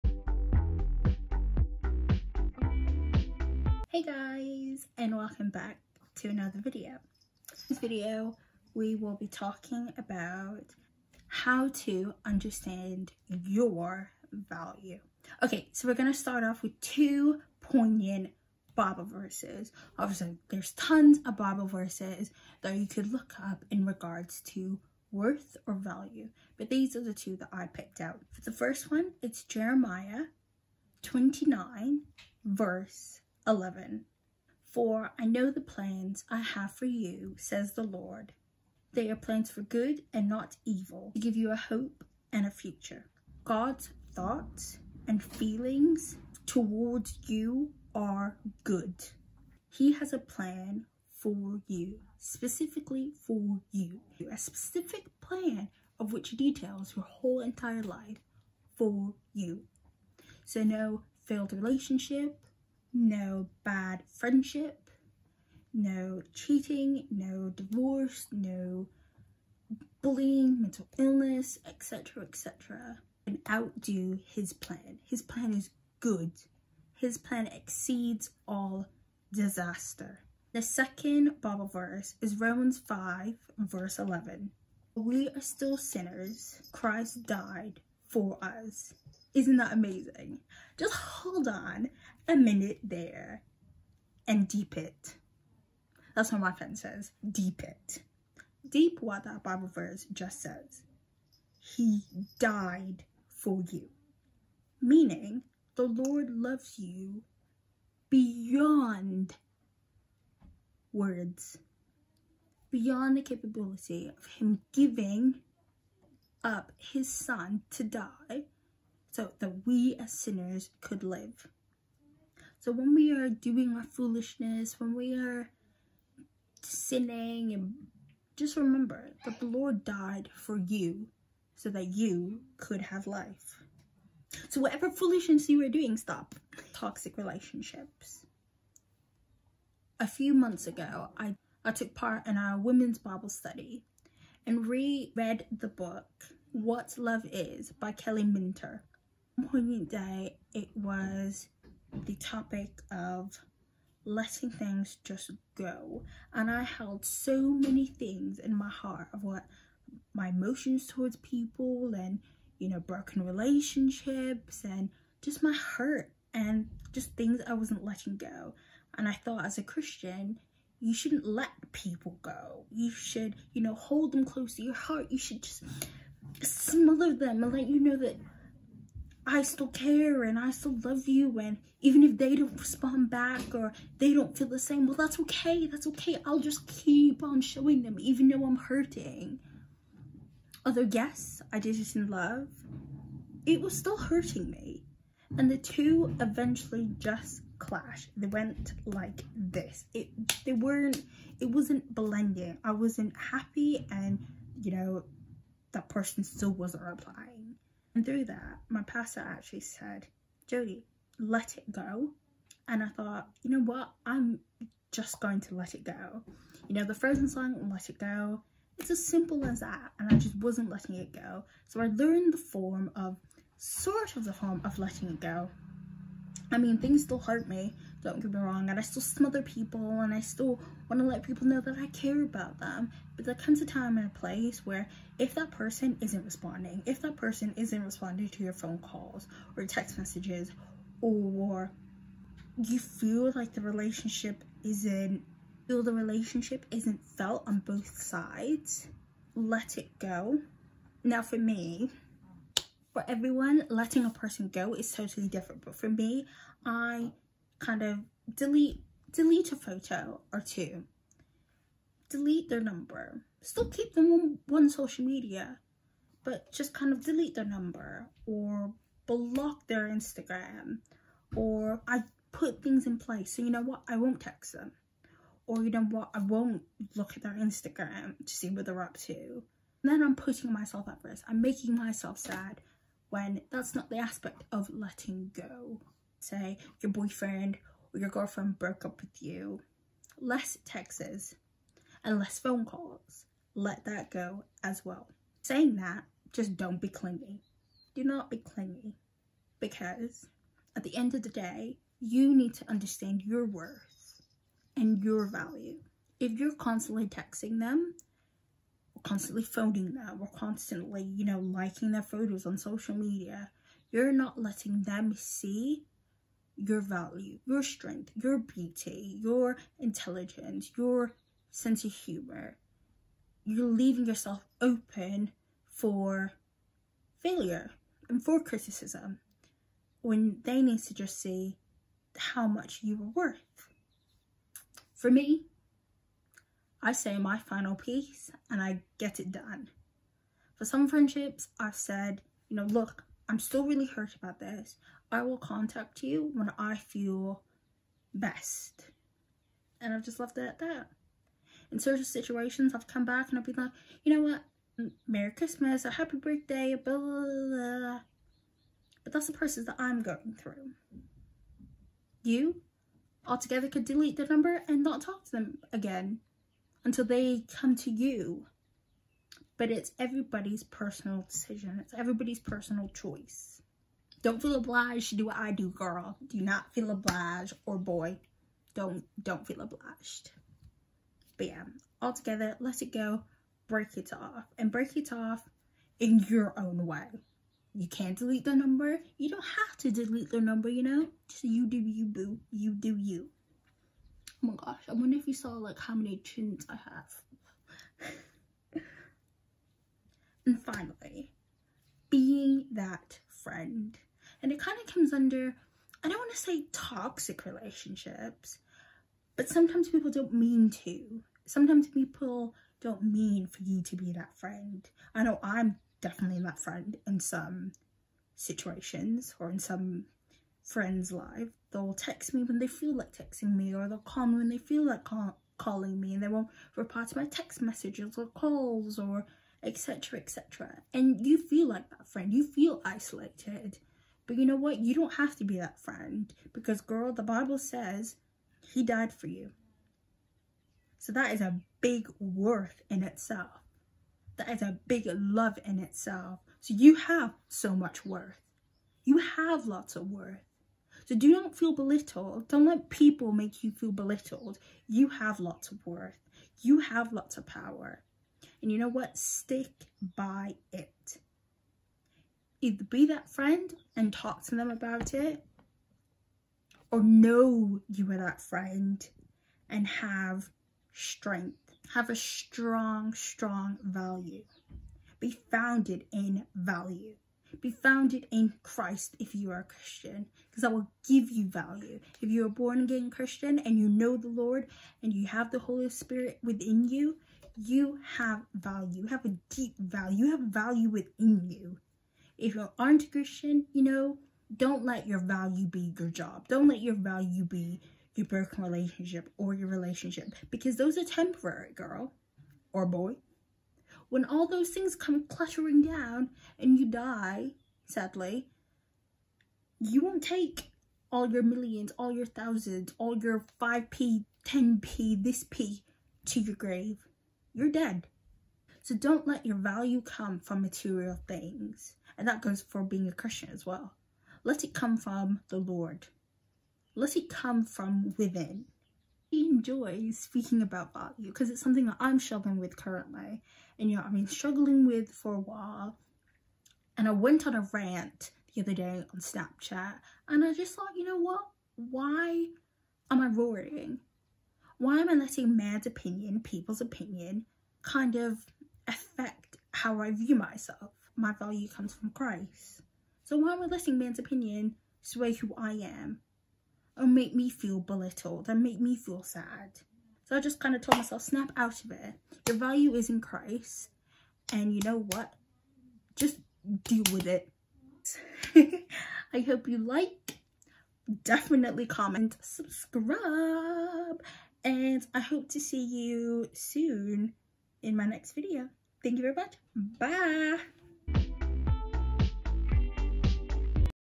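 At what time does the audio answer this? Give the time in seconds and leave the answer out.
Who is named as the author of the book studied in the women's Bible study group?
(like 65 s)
147 s.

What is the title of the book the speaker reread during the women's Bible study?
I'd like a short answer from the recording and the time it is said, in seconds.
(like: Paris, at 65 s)
What Love Is, at 146 s.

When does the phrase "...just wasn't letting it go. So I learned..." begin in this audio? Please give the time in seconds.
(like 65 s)
220 s.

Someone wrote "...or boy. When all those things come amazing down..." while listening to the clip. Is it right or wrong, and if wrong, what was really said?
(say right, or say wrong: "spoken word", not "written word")
wrong: "cluttering", not "amazing".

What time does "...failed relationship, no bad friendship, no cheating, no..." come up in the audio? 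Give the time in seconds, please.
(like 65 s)
61 s.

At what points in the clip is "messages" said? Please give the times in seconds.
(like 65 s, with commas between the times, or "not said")
239 s, 427 s.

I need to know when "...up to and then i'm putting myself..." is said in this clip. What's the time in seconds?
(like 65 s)
278 s.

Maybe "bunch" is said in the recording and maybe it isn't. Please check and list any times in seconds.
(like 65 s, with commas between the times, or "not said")
not said.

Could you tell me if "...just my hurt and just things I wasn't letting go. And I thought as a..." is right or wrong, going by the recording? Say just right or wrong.
right.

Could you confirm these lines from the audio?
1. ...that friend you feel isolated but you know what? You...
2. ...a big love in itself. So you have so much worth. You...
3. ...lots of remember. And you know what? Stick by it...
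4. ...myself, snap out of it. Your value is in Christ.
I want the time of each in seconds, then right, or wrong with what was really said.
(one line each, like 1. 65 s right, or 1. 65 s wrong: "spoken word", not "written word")
1. 431 s right
2. 444 s right
3. 457 s wrong: "power", not "remember"
4. 560 s right.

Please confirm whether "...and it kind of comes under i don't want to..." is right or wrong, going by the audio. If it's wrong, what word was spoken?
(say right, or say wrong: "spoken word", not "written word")
right.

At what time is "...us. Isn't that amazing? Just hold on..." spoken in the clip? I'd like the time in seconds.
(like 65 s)
88 s.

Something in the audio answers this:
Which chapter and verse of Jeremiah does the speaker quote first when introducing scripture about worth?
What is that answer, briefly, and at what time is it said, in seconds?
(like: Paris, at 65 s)
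Jeremiah 29:11, at 29 s.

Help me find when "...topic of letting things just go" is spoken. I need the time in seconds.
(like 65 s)
152 s.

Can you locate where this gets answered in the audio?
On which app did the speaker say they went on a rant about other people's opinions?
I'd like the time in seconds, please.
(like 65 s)
539 s.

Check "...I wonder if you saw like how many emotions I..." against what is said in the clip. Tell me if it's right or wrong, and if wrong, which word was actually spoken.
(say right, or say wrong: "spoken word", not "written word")
wrong: "chins", not "emotions".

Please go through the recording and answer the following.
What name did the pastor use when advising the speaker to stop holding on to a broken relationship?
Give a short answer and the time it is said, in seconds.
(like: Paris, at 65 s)
Jodie, at 210 s.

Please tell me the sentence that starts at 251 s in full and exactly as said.
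Now for me, for everyone, letting a person go is totally different.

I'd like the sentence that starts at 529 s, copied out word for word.
Enjoy speaking about value because it's something that I'm struggling with currently.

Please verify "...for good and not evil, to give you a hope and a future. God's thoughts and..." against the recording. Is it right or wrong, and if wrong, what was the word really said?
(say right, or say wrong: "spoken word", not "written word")
right.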